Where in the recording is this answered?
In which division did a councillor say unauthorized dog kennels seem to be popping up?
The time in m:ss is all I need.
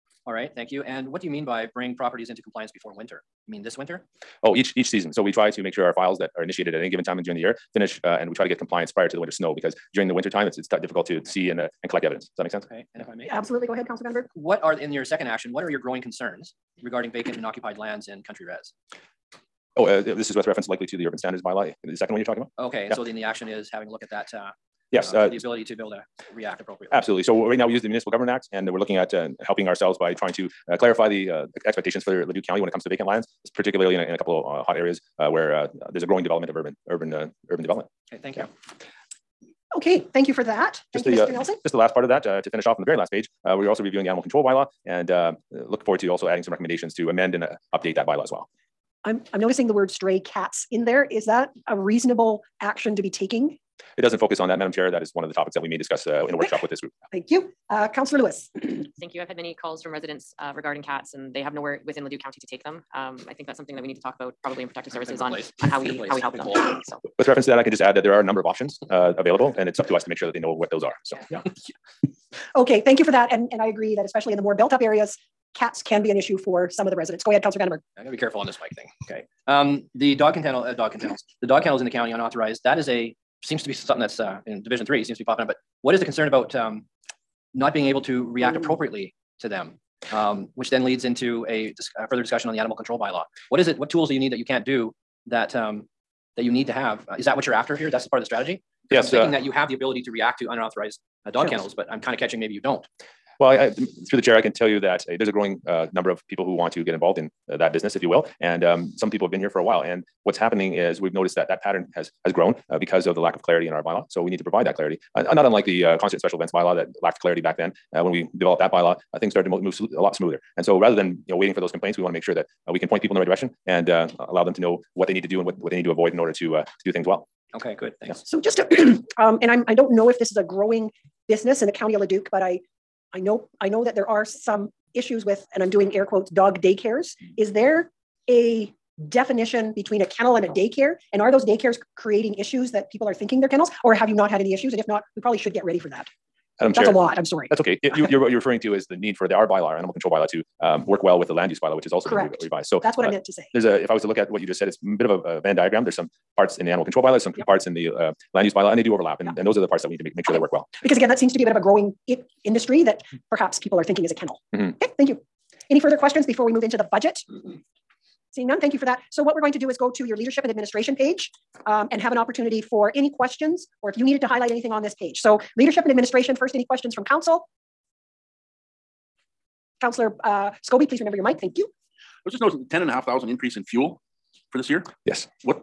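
1:24.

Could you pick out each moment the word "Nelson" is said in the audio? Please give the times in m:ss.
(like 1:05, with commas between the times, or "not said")
0:41.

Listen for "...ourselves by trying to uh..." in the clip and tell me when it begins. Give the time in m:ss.
0:29.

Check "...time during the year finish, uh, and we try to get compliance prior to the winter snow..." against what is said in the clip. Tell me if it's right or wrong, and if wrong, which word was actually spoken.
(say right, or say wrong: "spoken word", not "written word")
right.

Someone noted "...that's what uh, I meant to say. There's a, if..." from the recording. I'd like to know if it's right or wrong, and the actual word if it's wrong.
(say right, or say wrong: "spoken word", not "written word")
right.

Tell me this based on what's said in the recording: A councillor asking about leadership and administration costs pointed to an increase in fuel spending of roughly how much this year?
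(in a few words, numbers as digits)
10,500.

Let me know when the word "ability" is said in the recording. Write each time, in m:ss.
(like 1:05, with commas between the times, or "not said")
0:25, 1:39.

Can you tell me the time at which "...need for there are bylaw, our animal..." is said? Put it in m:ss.
2:28.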